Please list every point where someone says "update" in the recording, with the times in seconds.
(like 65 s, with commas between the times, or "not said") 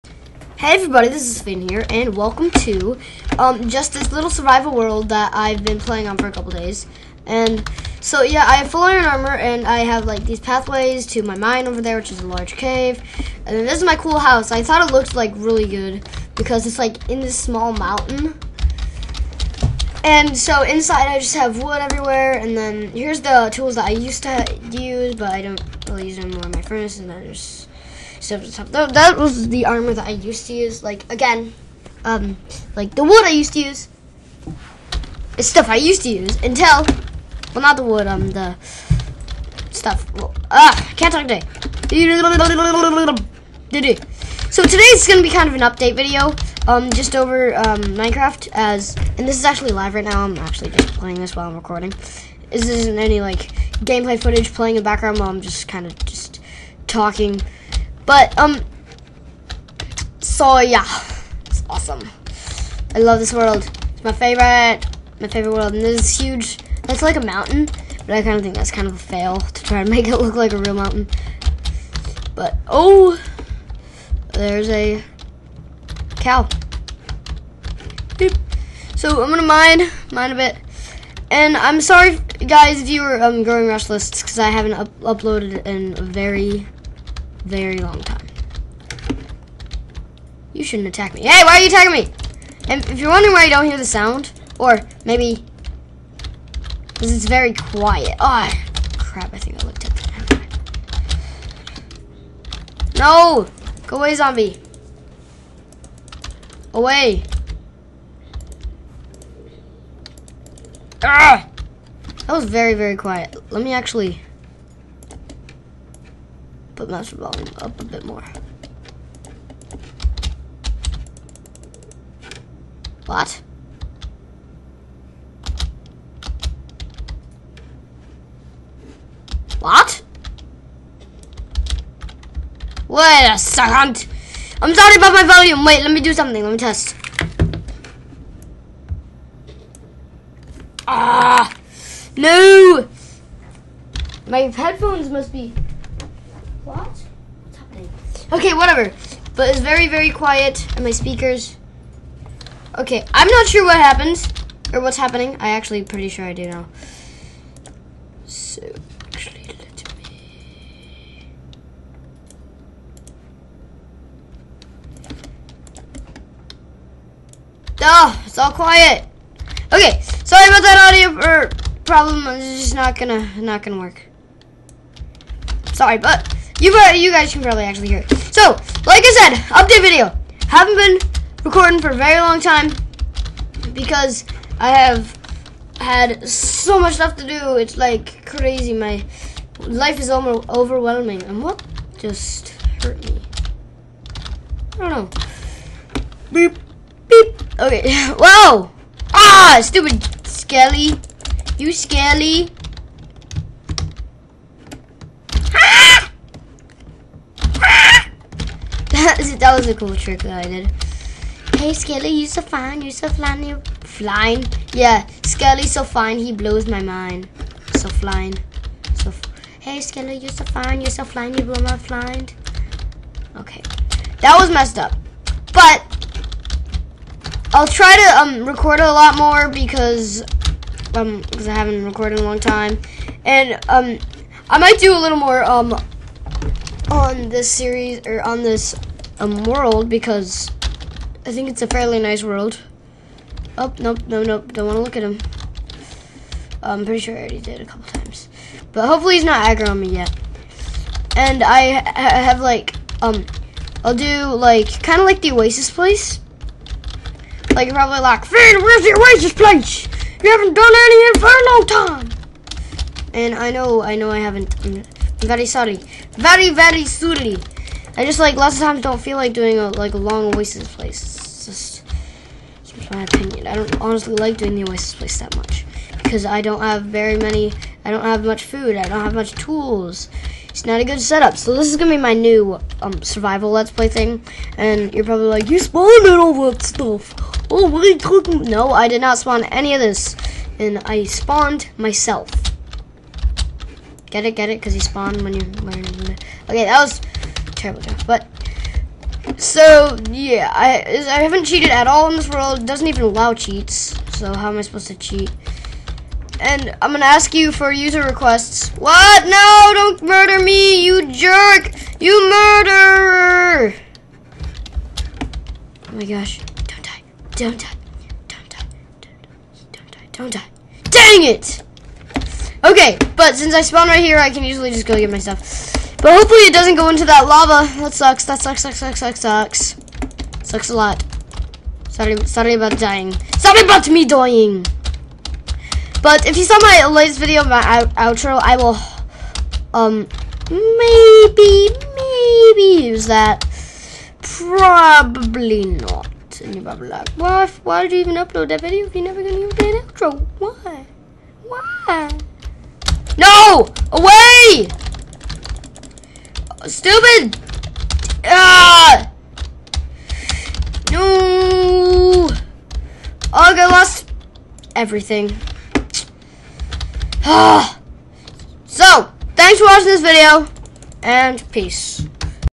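45 s, 179 s.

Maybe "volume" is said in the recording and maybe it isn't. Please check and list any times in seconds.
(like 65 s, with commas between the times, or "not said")
117 s, 135 s.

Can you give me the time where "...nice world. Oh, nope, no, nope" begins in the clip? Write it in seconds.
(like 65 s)
241 s.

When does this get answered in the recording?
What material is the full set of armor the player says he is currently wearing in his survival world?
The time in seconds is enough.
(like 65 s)
8 s.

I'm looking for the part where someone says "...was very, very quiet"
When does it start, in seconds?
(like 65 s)
112 s.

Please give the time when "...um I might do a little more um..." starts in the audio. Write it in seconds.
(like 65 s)
233 s.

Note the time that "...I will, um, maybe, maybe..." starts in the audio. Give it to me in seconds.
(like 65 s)
338 s.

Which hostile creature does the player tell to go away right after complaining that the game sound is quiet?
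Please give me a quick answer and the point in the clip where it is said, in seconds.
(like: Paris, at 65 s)
Zombie, at 103 s.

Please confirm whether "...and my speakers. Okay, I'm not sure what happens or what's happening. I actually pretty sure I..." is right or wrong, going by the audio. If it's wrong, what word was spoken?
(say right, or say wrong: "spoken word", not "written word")
right.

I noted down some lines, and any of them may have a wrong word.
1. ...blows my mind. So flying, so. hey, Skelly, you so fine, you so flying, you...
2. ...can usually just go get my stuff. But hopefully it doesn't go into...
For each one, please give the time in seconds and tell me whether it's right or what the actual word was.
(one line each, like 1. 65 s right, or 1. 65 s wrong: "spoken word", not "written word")
1. 216 s right
2. 324 s right.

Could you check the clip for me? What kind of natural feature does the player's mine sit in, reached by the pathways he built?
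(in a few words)
A large cave.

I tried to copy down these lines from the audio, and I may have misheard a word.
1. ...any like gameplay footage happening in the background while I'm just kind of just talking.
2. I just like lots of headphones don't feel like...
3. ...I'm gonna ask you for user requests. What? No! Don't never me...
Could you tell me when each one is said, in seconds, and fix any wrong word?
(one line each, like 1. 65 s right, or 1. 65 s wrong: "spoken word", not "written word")
1. 52 s wrong: "playing", not "happening"
2. 267 s wrong: "times", not "headphones"
3. 306 s wrong: "murder", not "never".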